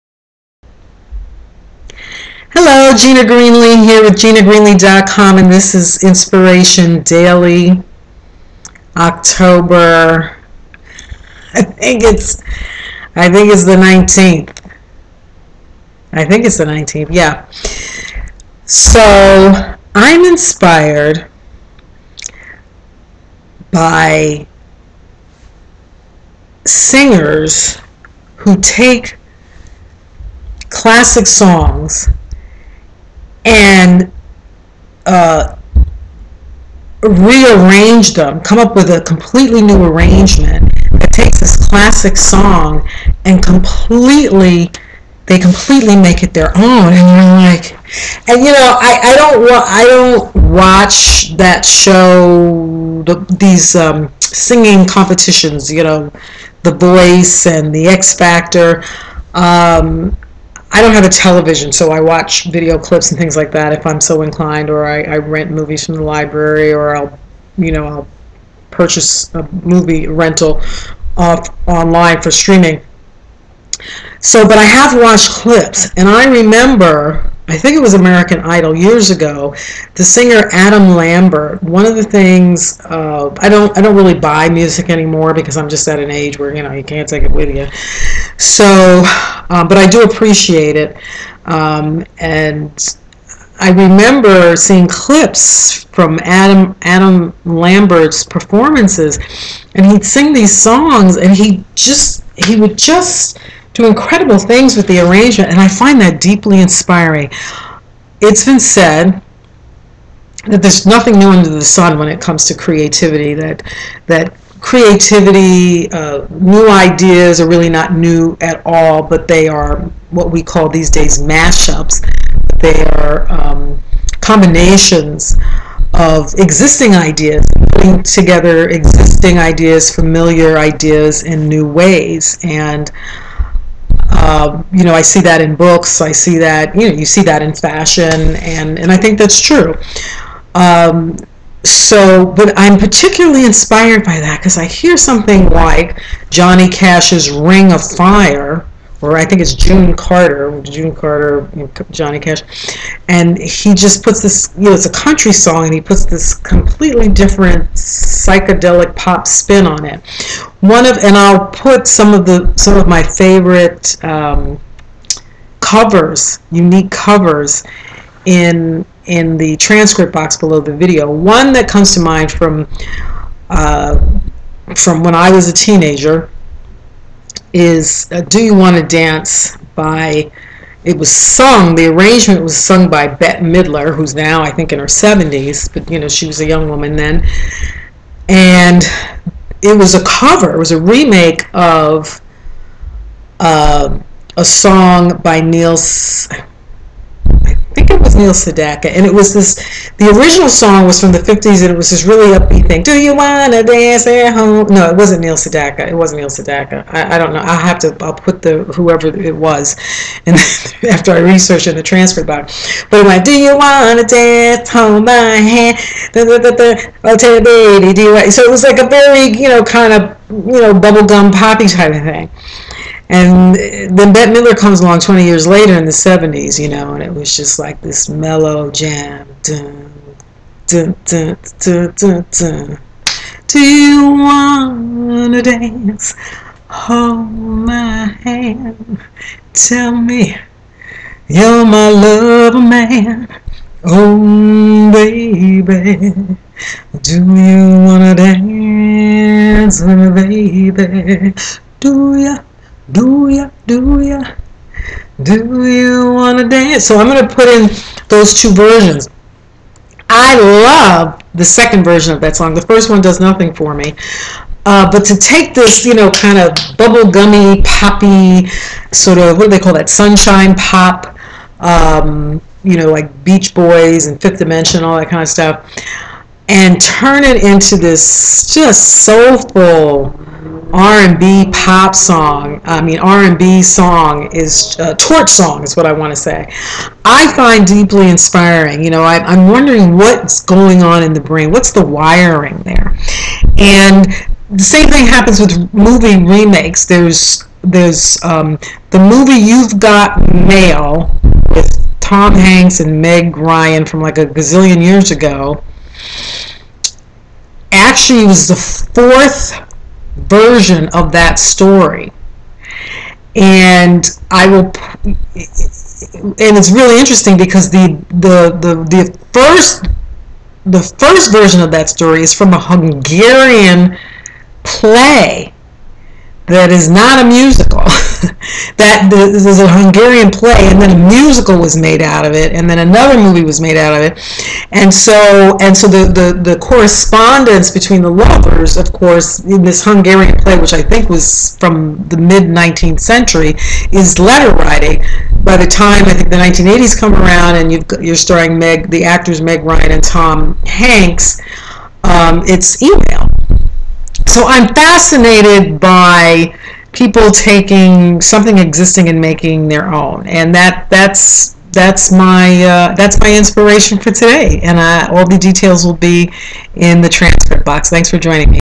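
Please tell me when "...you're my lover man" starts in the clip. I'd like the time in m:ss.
4:01.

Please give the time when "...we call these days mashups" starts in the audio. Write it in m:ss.
2:00.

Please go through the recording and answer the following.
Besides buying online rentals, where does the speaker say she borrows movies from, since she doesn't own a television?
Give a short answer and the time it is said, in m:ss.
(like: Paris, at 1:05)
the library, at 1:06.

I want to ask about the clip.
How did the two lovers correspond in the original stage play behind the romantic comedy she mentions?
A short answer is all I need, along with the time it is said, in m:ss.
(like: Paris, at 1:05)
letter writing, at 5:44.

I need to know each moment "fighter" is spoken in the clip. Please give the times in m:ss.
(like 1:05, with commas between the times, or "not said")
not said.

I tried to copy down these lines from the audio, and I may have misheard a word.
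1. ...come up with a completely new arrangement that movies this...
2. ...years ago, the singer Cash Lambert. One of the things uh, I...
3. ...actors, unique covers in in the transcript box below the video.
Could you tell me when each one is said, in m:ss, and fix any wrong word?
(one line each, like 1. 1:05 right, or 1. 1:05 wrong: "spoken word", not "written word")
1. 0:38 wrong: "takes", not "movies"
2. 1:18 wrong: "Adam", not "Cash"
3. 2:45 wrong: "covers", not "actors".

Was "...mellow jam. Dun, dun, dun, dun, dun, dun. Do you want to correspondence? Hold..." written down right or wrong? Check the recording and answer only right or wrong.
wrong.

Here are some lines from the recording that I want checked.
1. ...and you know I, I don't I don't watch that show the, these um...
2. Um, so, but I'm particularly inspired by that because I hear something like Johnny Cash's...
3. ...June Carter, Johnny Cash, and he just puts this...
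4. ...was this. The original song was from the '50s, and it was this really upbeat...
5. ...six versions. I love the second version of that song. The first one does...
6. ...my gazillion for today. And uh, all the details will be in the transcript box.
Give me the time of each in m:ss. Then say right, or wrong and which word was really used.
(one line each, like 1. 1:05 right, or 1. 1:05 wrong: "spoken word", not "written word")
1. 0:48 right
2. 2:20 right
3. 2:30 right
4. 3:19 right
5. 4:18 wrong: "two", not "six"
6. 6:03 wrong: "inspiration", not "gazillion".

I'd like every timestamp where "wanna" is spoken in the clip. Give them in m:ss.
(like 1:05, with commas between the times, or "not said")
3:23, 3:33, 4:16.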